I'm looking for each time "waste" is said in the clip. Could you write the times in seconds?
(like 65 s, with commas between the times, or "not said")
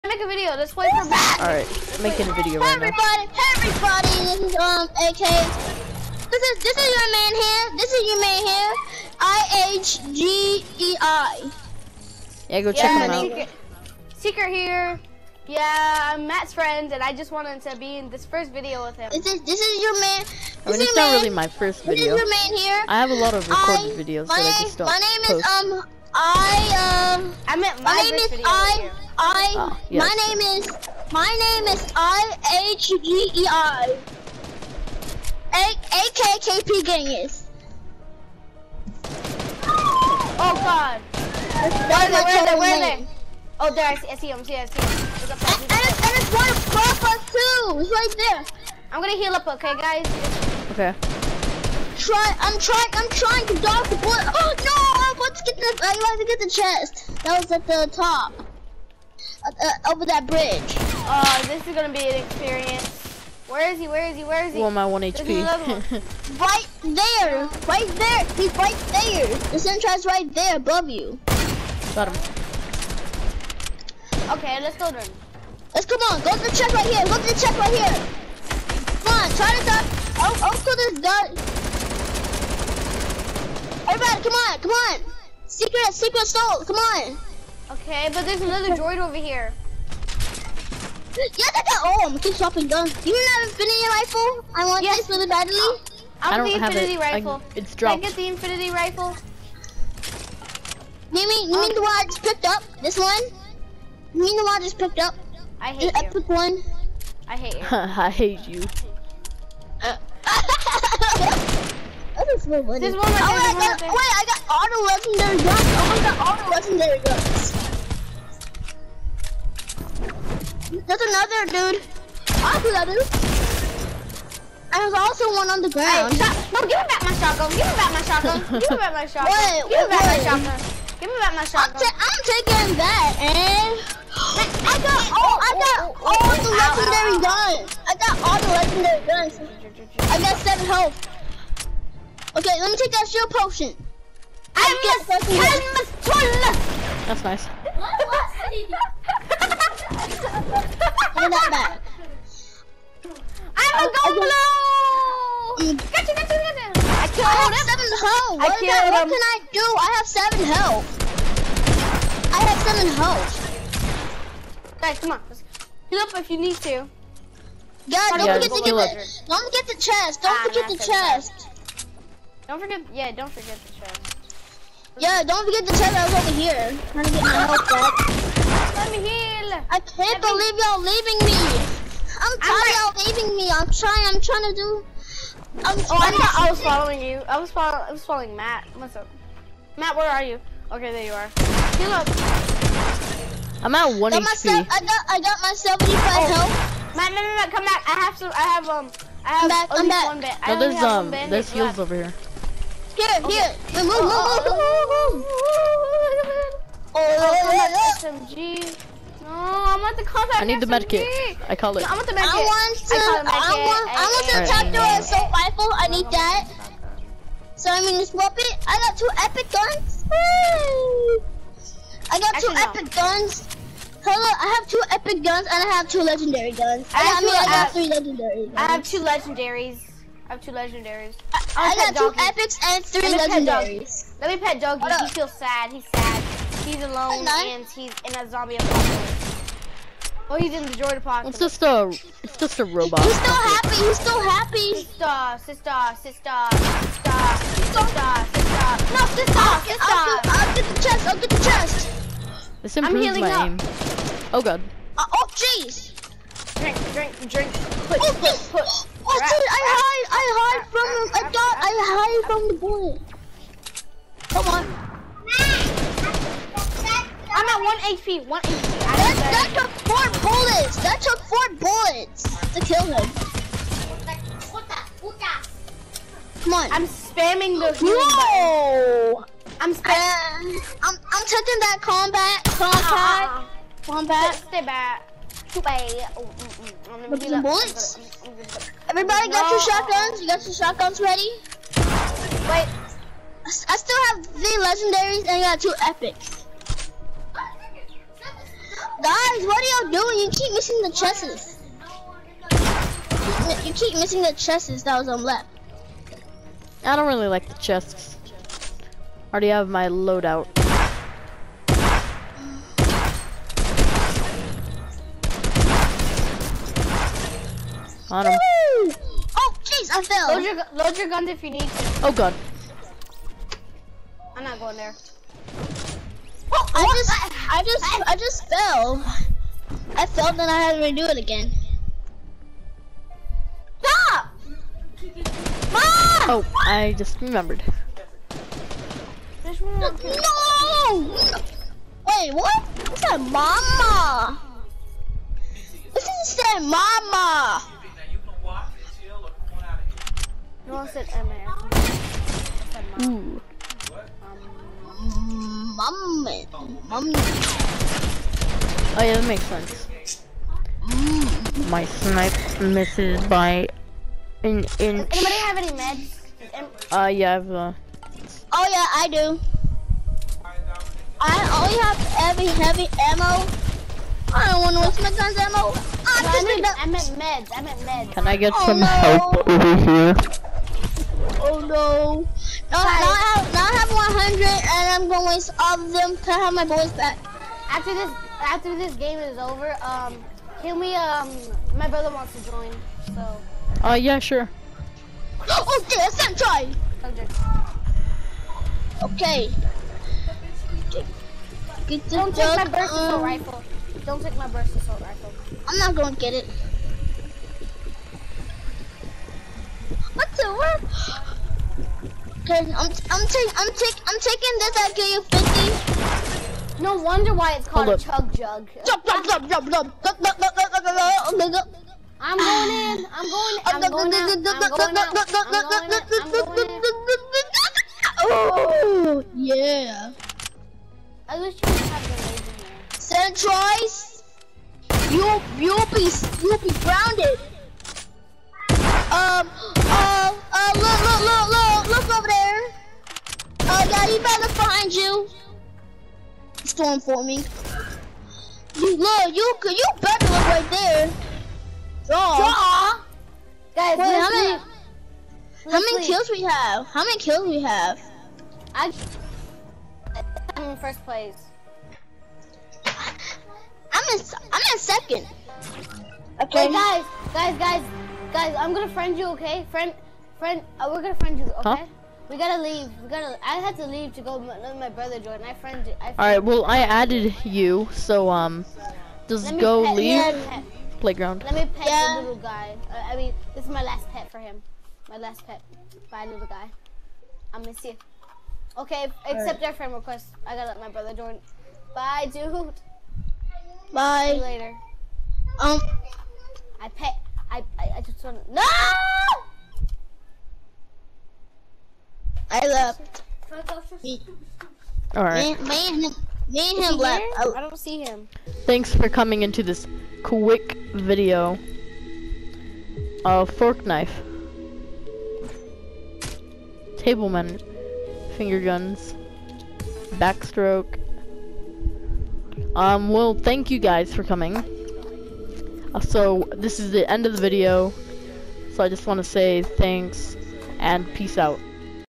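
374 s.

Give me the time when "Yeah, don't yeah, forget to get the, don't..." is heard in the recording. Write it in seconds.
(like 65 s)
167 s.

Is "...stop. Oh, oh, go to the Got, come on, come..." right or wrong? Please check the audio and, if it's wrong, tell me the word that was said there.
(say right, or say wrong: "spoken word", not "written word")
wrong: "Everybody", not "Got".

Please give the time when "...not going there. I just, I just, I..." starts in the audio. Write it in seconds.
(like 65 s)
324 s.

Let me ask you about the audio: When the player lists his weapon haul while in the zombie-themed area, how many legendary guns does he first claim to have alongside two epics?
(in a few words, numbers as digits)
3.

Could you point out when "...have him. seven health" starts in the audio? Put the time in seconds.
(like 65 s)
158 s.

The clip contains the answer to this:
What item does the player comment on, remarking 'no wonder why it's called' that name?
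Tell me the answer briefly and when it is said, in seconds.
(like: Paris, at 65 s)
chug jug, at 418 s.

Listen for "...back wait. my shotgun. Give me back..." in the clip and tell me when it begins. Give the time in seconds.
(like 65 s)
129 s.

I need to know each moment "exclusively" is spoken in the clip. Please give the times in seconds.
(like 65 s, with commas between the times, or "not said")
not said.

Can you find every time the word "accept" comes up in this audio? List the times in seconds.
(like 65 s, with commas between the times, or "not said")
489 s.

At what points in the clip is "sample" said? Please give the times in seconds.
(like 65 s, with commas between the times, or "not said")
not said.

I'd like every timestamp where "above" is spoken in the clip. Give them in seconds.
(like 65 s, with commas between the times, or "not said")
46 s, 70 s.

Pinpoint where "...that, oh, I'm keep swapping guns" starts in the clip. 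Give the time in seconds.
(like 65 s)
91 s.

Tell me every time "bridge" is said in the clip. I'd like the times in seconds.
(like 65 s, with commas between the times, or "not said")
60 s.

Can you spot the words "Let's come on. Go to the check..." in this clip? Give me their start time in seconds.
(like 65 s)
75 s.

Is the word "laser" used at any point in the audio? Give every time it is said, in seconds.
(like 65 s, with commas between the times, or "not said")
432 s.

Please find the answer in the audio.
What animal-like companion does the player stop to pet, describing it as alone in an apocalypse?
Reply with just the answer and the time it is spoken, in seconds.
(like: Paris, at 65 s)
Doggy, at 234 s.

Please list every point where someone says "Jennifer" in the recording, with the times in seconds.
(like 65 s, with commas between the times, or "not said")
not said.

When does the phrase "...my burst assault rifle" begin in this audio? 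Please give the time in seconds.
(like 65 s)
404 s.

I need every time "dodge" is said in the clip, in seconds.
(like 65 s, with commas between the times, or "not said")
53 s.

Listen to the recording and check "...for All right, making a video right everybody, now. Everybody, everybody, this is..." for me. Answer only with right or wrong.
right.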